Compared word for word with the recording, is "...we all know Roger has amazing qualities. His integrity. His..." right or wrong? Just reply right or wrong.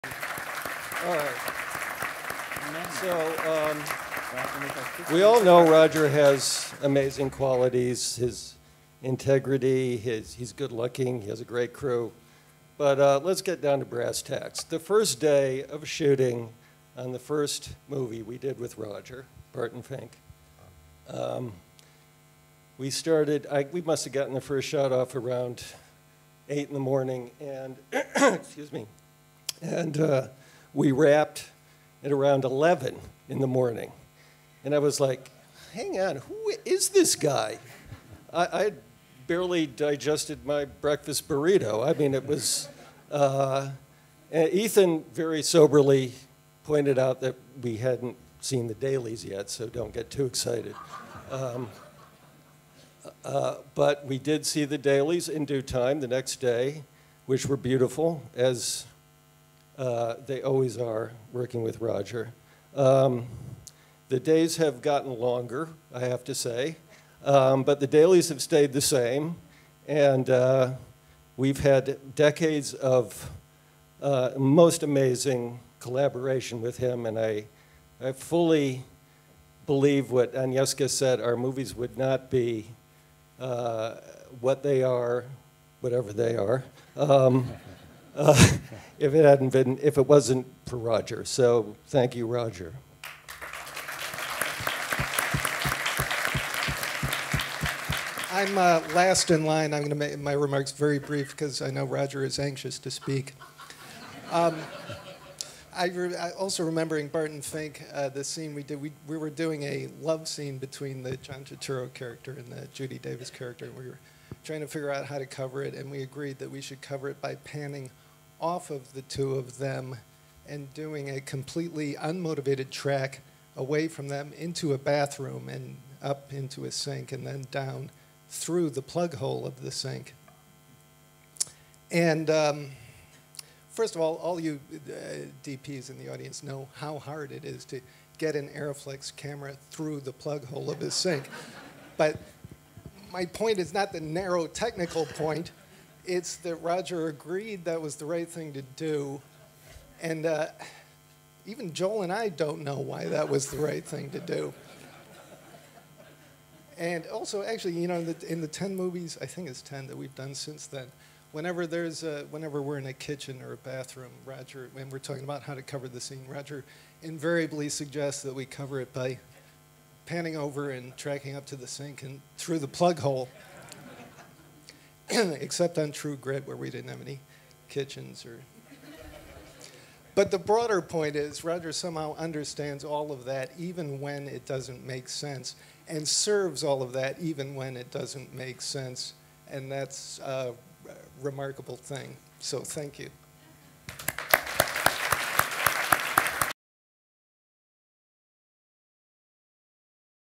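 right.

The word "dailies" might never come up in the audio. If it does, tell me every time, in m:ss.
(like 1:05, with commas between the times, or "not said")
0:48, 0:54, 1:07.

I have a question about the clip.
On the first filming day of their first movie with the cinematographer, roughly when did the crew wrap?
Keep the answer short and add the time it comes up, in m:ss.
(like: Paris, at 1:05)
11 in the morning, at 0:32.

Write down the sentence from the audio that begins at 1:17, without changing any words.
And I, I fully believe what Agnieszka said our movies would not be uh, what they are, whatever they are.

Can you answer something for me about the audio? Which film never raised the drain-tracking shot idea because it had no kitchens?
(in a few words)
True Grit.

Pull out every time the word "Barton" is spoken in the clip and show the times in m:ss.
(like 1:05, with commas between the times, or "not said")
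0:19, 1:47.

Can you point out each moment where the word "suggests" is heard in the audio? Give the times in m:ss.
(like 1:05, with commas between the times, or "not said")
2:47.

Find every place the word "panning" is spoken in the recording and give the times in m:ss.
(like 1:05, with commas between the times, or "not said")
1:57, 2:50.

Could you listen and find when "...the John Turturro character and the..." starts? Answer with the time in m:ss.
1:51.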